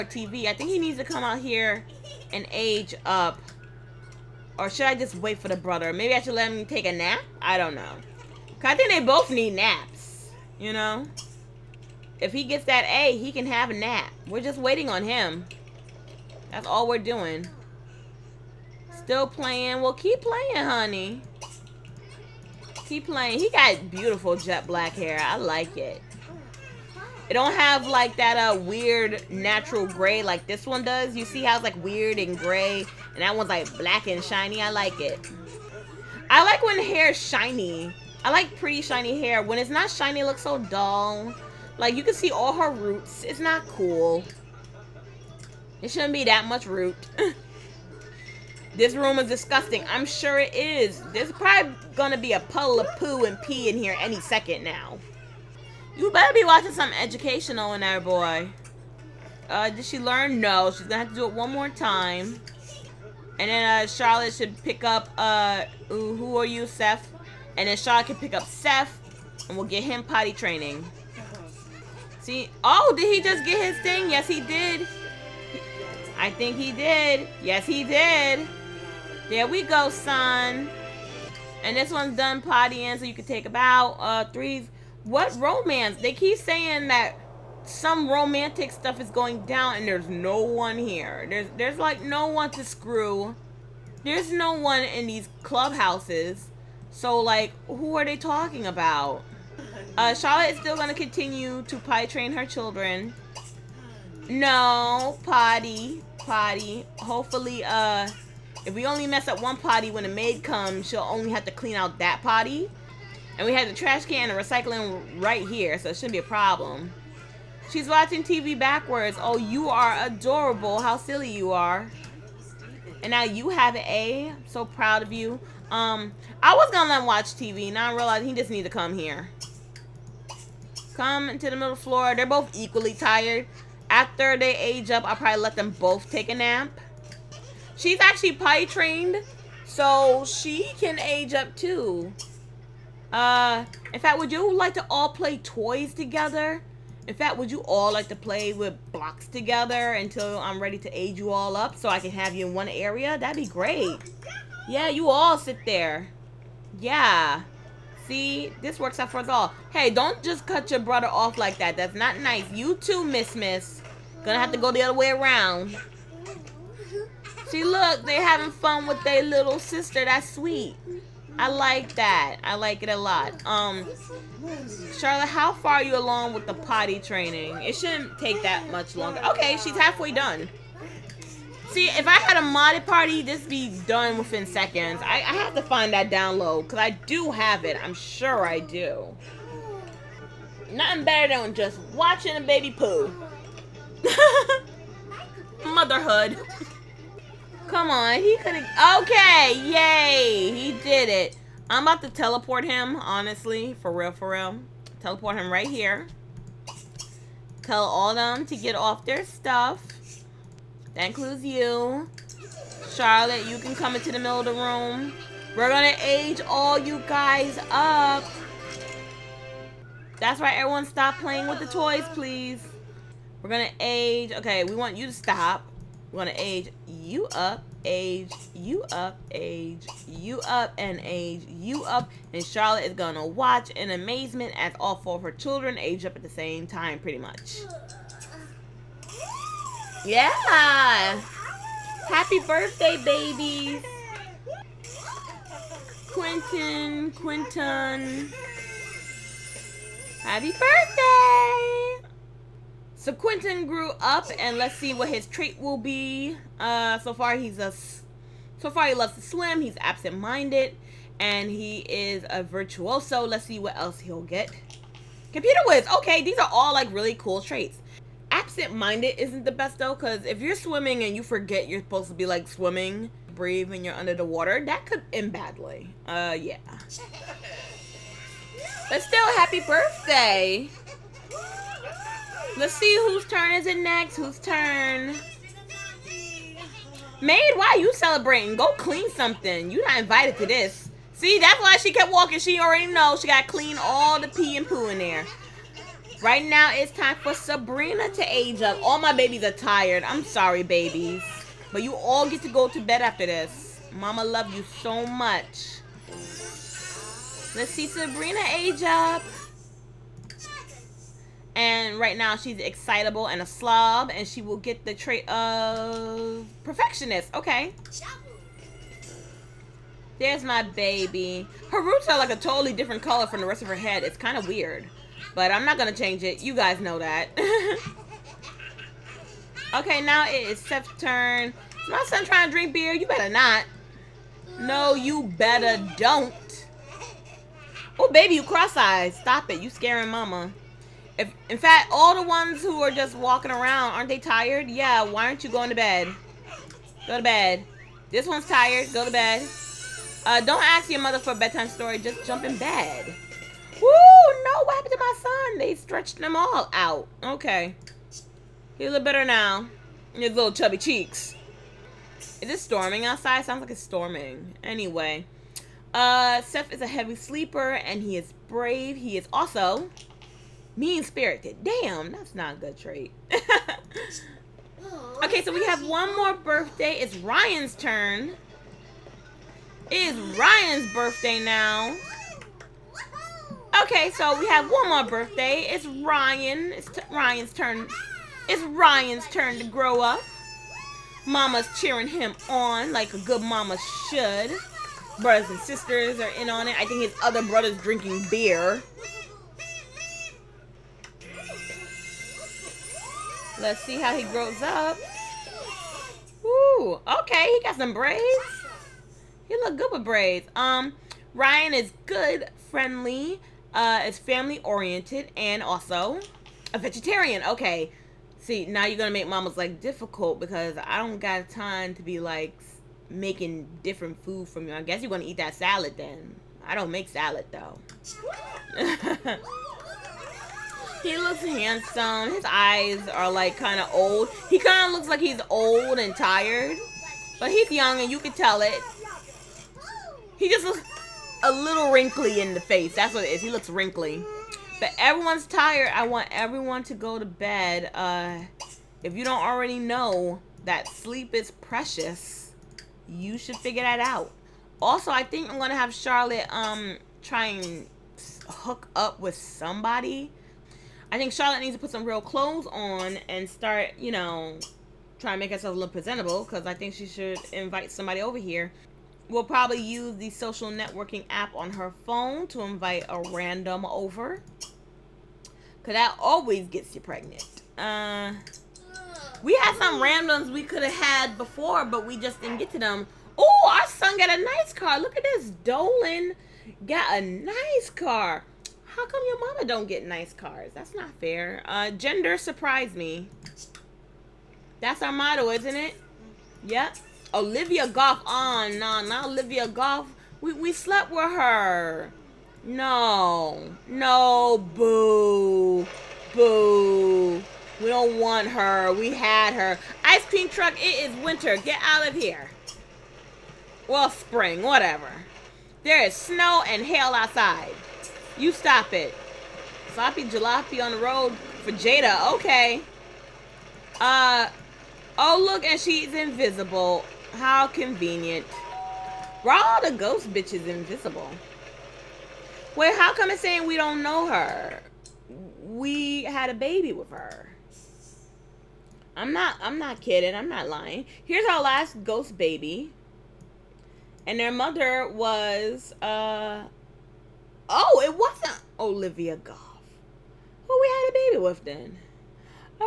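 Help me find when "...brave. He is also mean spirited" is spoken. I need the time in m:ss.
6:08.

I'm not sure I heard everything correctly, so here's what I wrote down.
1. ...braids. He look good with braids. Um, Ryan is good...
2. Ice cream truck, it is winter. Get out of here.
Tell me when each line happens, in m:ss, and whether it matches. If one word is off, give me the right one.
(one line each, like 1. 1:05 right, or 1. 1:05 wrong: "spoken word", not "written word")
1. 6:47 right
2. 8:30 right.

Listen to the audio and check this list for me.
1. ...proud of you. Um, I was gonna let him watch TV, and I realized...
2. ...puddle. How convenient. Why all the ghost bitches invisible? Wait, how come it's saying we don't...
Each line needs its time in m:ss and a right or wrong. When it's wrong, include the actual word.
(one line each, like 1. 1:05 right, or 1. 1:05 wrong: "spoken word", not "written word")
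1. 2:04 right
2. 8:46 wrong: "invisible", not "puddle".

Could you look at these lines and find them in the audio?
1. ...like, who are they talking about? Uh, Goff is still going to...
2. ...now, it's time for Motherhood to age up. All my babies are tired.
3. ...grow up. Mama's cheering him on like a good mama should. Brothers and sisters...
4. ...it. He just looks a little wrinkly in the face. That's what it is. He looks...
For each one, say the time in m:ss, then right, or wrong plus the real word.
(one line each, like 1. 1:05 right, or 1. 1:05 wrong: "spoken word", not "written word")
1. 1:37 wrong: "Charlotte", not "Goff"
2. 4:56 wrong: "Sabrina", not "Motherhood"
3. 6:29 right
4. 7:18 right.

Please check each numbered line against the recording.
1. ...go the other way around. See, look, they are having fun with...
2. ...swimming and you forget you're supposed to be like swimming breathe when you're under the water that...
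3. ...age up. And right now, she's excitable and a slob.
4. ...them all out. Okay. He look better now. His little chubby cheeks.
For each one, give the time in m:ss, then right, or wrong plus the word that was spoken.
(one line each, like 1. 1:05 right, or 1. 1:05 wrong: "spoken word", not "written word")
1. 2:44 right
2. 4:30 right
3. 5:08 right
4. 5:56 right.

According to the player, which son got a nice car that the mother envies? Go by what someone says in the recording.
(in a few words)
Dolan.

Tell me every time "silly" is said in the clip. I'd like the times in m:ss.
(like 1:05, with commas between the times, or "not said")
2:00.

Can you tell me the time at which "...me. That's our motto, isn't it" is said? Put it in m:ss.
8:12.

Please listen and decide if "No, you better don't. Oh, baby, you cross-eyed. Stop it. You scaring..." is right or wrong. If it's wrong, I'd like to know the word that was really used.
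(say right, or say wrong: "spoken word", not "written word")
right.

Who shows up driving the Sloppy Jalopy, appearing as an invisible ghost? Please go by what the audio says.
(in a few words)
Jada.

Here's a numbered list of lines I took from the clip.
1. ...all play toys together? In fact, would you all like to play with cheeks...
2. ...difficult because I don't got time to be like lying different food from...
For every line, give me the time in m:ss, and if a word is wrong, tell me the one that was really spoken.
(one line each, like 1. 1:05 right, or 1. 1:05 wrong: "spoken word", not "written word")
1. 2:24 wrong: "blocks", not "cheeks"
2. 6:59 wrong: "making", not "lying".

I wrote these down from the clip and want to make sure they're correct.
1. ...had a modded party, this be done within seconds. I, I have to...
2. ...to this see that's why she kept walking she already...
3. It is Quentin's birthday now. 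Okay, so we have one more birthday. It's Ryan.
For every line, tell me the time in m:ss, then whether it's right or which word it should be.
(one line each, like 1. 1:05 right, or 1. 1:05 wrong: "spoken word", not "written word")
1. 3:02 right
2. 4:50 right
3. 6:19 wrong: "Ryan", not "Quentin".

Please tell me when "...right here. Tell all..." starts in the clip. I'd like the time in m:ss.
3:25.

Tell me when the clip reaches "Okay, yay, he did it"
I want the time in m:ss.
3:19.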